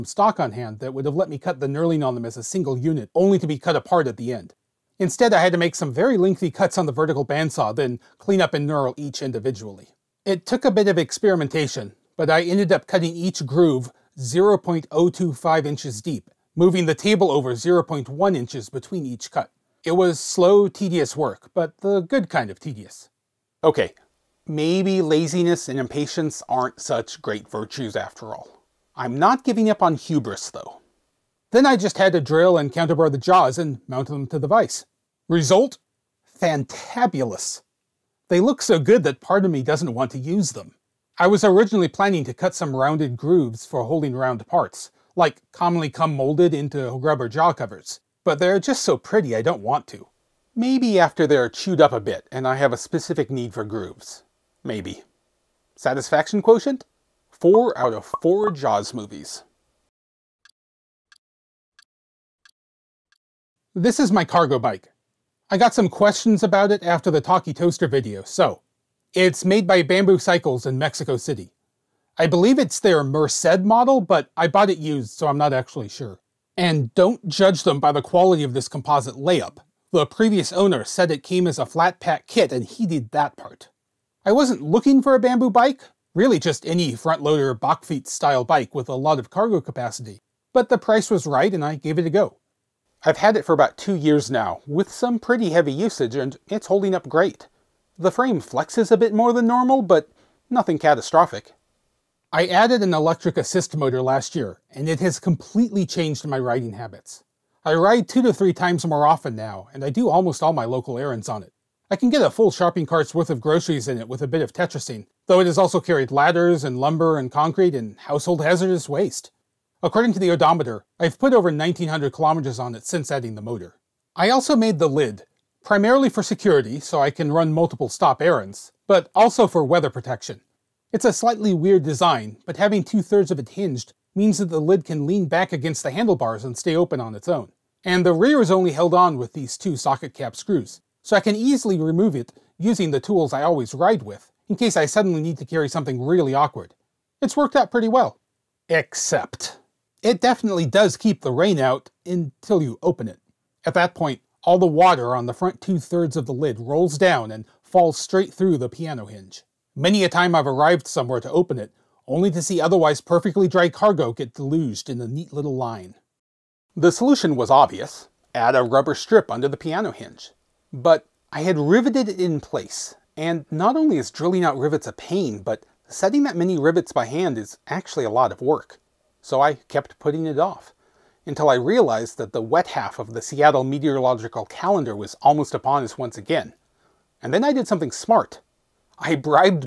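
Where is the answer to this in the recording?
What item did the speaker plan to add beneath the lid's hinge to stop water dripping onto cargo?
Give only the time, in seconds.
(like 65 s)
168 s.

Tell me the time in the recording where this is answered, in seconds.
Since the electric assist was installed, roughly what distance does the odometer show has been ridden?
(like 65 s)
121 s.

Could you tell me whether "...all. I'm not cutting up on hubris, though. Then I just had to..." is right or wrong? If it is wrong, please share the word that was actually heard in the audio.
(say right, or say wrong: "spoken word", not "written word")
wrong: "giving", not "cutting".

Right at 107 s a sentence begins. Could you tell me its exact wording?
I ride two to three times more often now, and I do almost all my local errands on it.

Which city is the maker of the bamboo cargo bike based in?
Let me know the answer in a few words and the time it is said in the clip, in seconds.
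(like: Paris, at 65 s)
Mexico City, at 70 s.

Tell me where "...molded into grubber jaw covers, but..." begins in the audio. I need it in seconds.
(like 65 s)
46 s.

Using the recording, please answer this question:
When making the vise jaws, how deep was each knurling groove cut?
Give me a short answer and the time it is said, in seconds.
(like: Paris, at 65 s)
0.025 inches, at 14 s.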